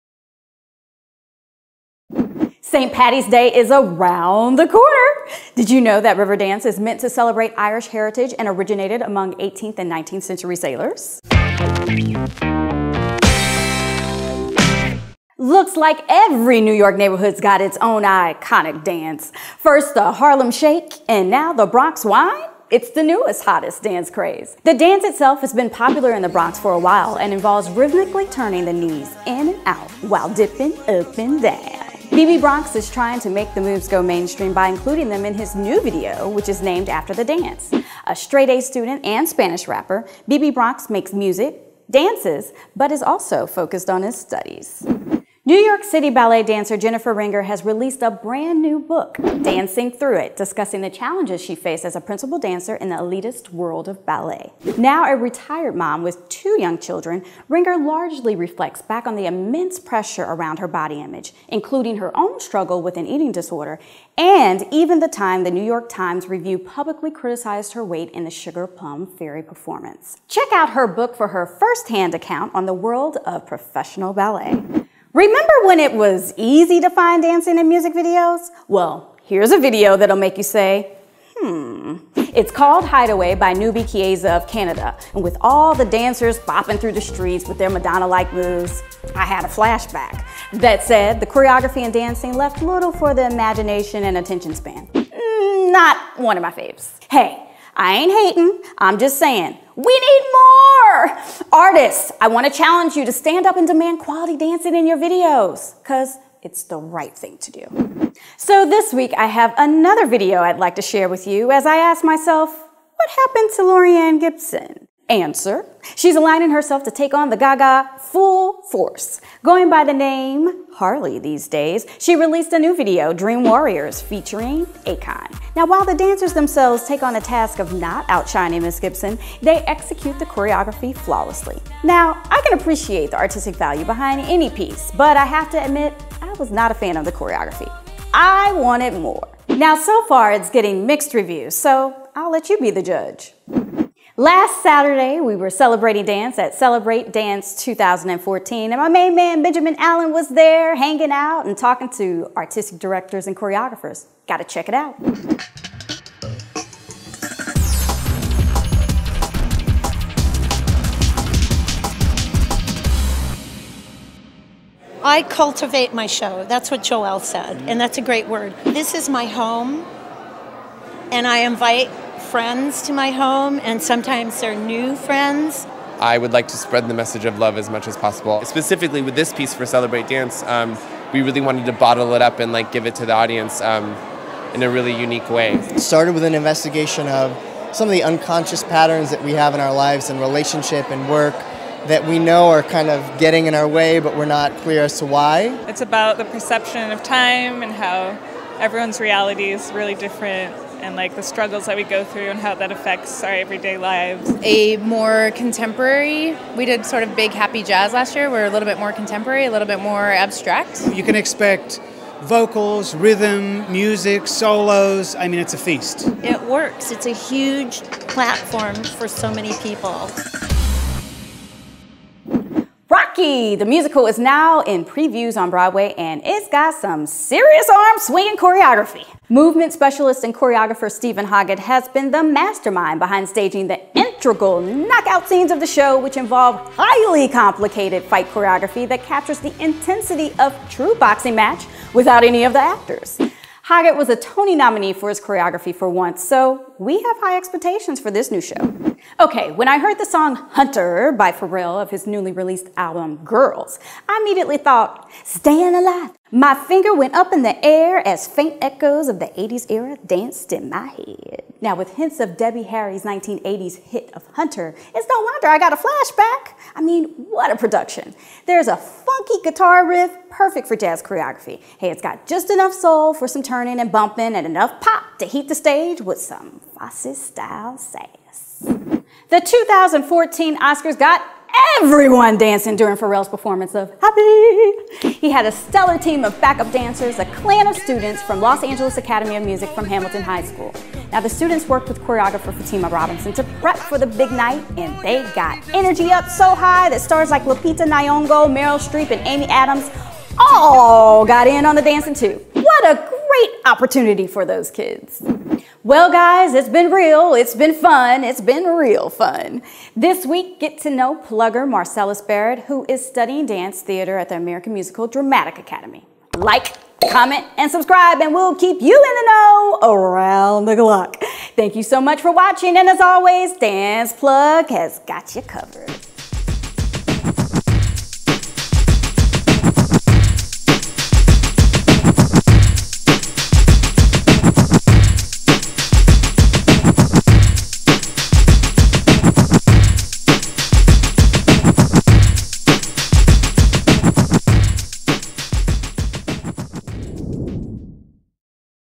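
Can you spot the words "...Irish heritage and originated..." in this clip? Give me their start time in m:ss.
0:07.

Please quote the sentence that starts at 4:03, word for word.
Hoggett was a Tony nominee for his choreography for once, so we have high expectations for this new show.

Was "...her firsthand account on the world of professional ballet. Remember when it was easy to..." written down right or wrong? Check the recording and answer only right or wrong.
right.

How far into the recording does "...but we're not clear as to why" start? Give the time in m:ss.
3:13.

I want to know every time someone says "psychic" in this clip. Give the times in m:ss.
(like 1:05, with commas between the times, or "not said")
not said.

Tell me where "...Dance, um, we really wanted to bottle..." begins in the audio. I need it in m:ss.
3:00.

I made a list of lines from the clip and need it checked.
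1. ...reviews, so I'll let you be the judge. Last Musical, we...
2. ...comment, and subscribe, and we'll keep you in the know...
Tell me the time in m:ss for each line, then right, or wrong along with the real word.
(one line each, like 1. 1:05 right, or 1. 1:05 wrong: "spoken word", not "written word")
1. 2:21 wrong: "Saturday", not "Musical"
2. 5:17 right.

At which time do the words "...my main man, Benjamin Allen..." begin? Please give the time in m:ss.
2:28.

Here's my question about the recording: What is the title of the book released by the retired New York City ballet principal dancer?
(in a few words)
Dancing Through It.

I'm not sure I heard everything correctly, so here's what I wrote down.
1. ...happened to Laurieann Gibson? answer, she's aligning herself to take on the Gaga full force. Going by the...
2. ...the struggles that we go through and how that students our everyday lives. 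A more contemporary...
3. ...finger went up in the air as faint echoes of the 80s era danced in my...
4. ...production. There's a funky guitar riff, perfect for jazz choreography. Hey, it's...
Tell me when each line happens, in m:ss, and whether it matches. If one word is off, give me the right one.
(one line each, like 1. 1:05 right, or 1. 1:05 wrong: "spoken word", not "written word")
1. 1:53 right
2. 3:21 wrong: "affects", not "students"
3. 4:16 right
4. 4:27 right.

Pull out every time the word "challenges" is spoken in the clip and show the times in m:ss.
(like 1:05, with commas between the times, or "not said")
0:50, 1:42.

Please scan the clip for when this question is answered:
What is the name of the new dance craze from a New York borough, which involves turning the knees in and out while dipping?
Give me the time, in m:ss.
0:21.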